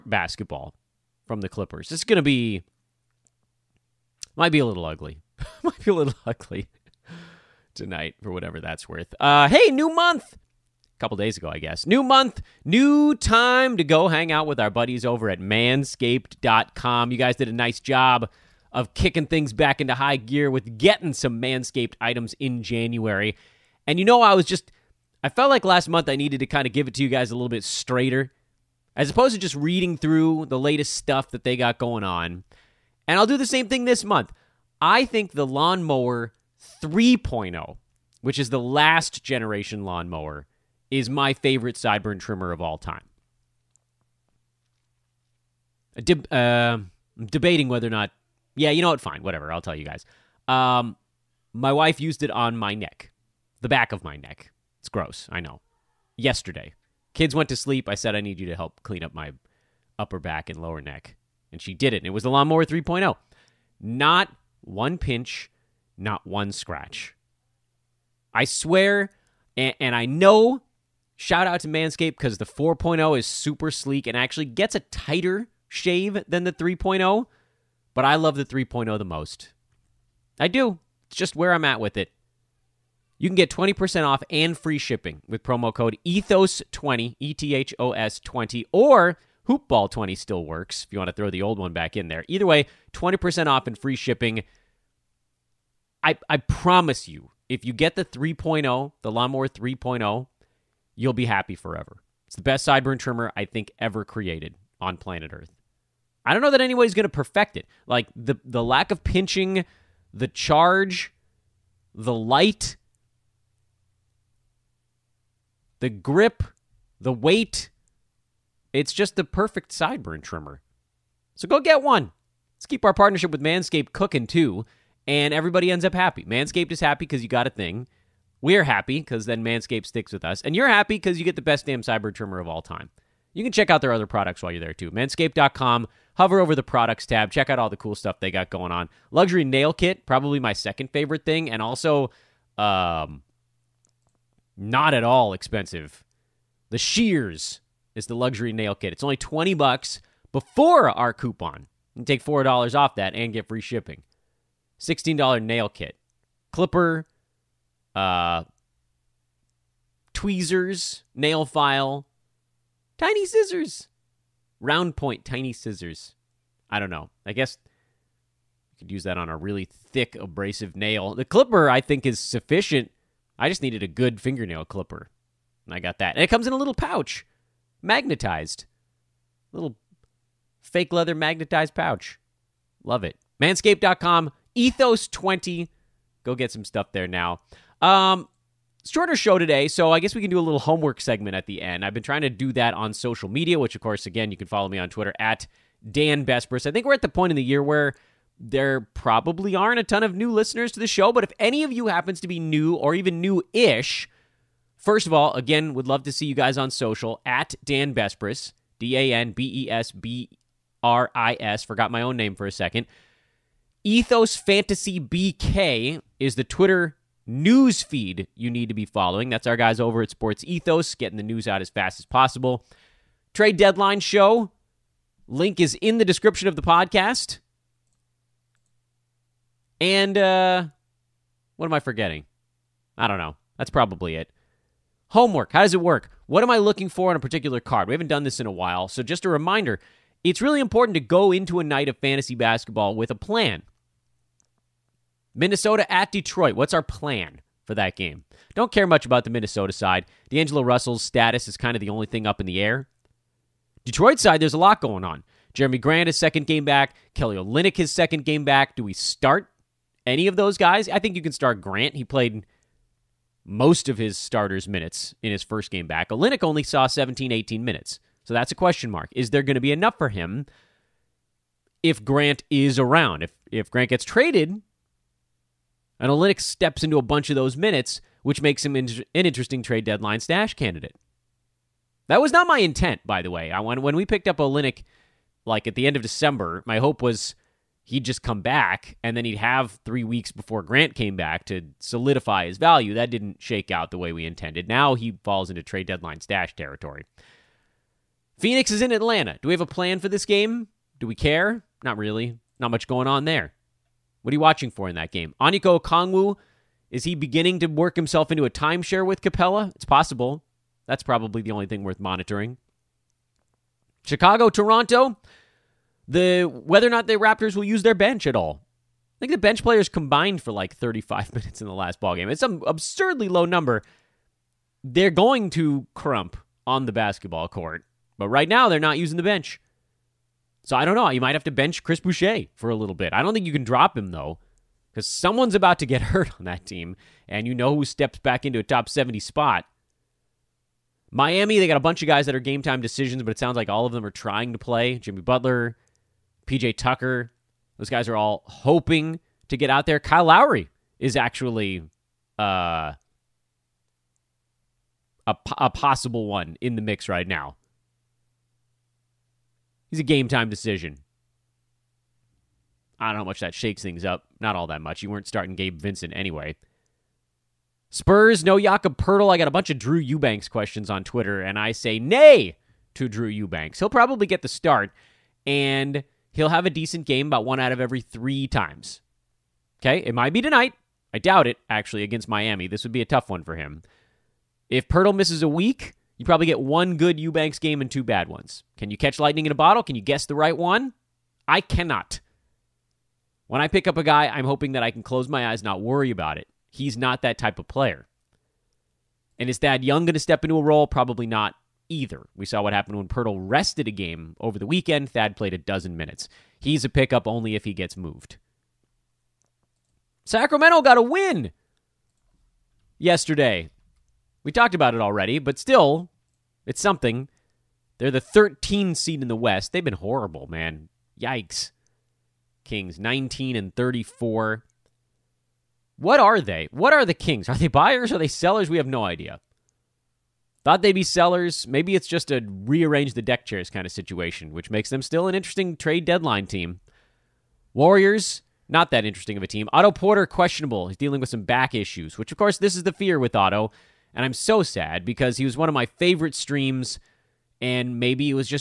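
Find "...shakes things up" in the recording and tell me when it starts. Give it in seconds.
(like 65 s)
363 s.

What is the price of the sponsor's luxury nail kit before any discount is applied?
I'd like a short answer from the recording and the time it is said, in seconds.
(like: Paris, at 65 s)
$20, at 149 s.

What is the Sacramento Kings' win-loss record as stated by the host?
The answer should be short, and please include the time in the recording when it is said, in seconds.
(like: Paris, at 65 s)
19-34, at 422 s.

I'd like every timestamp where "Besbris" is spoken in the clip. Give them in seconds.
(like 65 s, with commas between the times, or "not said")
196 s, 207 s.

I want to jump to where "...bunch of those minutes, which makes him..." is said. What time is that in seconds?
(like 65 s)
277 s.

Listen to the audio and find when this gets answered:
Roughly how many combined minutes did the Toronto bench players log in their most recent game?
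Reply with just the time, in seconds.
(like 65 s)
320 s.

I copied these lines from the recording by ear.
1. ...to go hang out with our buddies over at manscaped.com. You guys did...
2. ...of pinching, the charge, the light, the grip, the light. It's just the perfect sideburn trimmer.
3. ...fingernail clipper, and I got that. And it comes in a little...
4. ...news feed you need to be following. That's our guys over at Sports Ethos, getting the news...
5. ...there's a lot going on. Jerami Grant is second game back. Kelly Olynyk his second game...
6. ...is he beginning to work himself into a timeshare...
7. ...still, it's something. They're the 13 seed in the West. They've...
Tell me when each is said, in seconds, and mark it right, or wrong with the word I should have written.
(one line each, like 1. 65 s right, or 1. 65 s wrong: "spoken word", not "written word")
1. 13 s right
2. 108 s wrong: "weight", not "light"
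3. 174 s right
4. 217 s right
5. 254 s right
6. 306 s right
7. 415 s right.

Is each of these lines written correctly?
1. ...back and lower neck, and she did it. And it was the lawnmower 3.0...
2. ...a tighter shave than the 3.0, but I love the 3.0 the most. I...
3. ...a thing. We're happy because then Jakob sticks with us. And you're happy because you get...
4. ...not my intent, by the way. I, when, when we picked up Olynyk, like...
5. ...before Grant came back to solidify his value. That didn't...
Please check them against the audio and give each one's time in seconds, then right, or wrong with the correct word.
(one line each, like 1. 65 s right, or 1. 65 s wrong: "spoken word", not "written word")
1. 60 s right
2. 74 s right
3. 127 s wrong: "Manscaped", not "Jakob"
4. 282 s right
5. 290 s right.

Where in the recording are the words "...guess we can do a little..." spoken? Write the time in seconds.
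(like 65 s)
189 s.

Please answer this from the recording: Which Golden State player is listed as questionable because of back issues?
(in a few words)
Otto Porter.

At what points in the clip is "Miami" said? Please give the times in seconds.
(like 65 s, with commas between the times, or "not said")
341 s, 382 s.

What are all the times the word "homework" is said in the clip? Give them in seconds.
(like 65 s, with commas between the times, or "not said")
190 s, 235 s.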